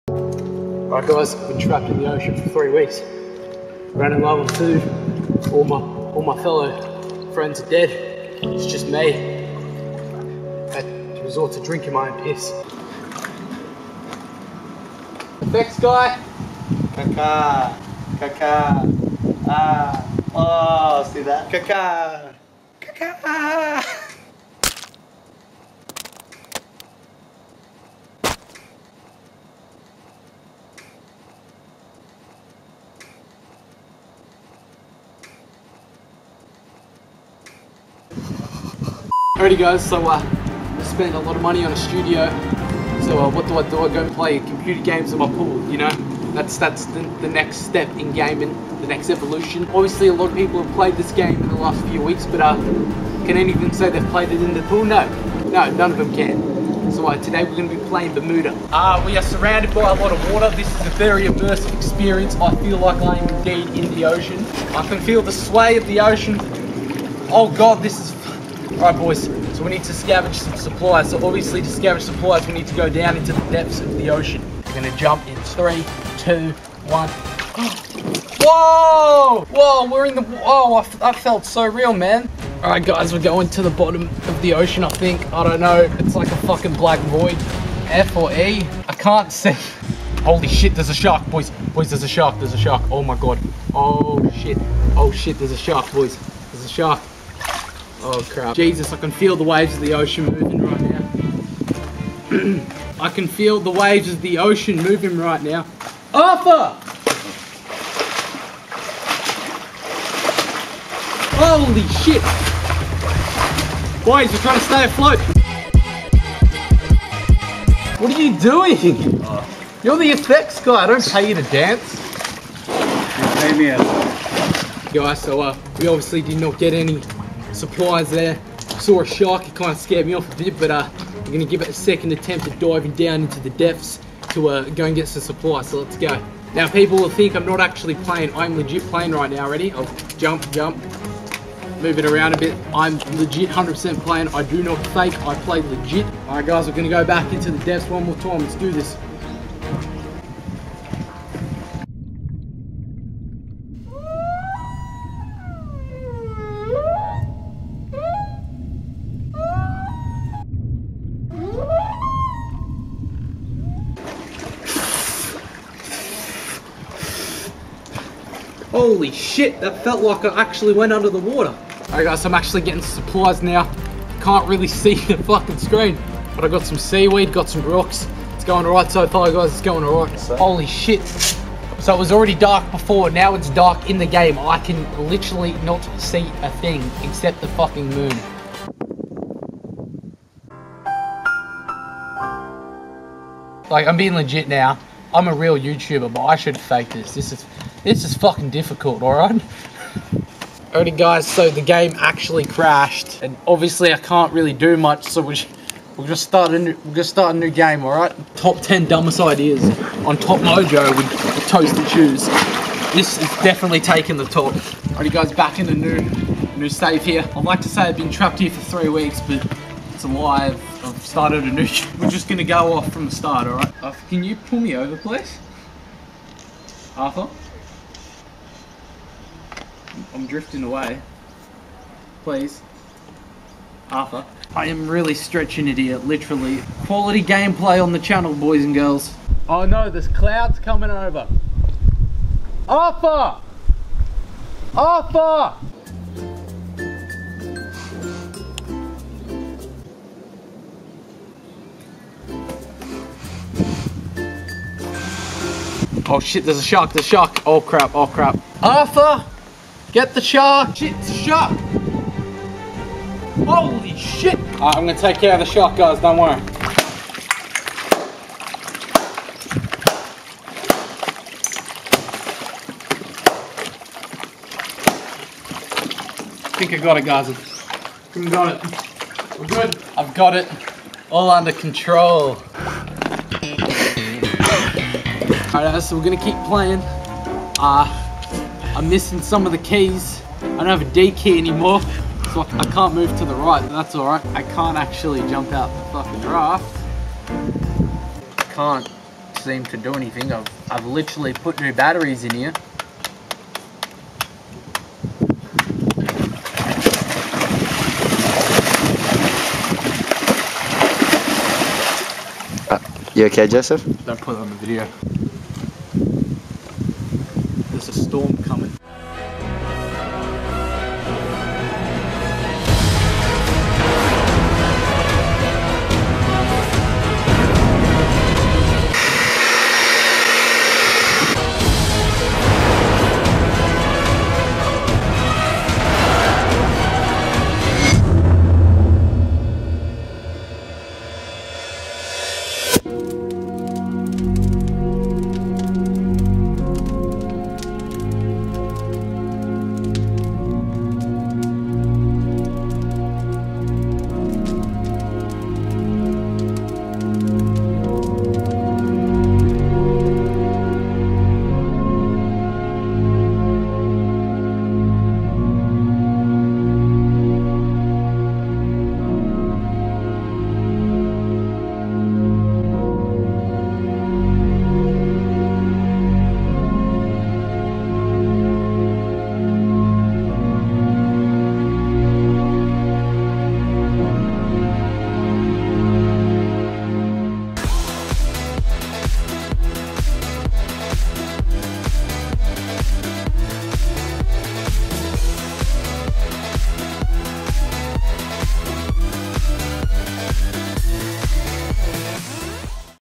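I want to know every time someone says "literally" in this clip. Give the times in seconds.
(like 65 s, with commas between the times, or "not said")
185 s, 235 s, 300 s.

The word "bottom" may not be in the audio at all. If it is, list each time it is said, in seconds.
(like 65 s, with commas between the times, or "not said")
83 s.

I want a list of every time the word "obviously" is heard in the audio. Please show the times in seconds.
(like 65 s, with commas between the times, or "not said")
49 s, 71 s, 125 s, 203 s.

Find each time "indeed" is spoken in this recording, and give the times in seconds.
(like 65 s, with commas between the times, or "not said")
63 s.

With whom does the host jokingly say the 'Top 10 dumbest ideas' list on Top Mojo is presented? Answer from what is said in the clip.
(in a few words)
ToastedShoes.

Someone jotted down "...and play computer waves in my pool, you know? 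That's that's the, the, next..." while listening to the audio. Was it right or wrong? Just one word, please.
wrong.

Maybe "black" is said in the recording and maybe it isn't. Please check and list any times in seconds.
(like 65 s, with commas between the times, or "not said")
86 s.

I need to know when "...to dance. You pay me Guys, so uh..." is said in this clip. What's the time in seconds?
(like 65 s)
121 s.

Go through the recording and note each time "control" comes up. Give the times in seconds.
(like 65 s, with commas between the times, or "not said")
281 s.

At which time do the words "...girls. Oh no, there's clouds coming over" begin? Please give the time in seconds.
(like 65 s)
238 s.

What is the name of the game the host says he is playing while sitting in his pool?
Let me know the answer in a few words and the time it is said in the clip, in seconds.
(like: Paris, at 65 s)
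Bermuda, at 58 s.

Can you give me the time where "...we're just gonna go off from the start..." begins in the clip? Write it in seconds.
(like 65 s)
221 s.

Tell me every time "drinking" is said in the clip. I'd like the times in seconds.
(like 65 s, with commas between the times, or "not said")
11 s.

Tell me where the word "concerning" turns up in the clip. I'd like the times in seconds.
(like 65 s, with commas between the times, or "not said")
not said.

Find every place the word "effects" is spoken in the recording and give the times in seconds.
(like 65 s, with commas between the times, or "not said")
120 s.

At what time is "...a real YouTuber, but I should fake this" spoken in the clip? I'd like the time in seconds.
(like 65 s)
195 s.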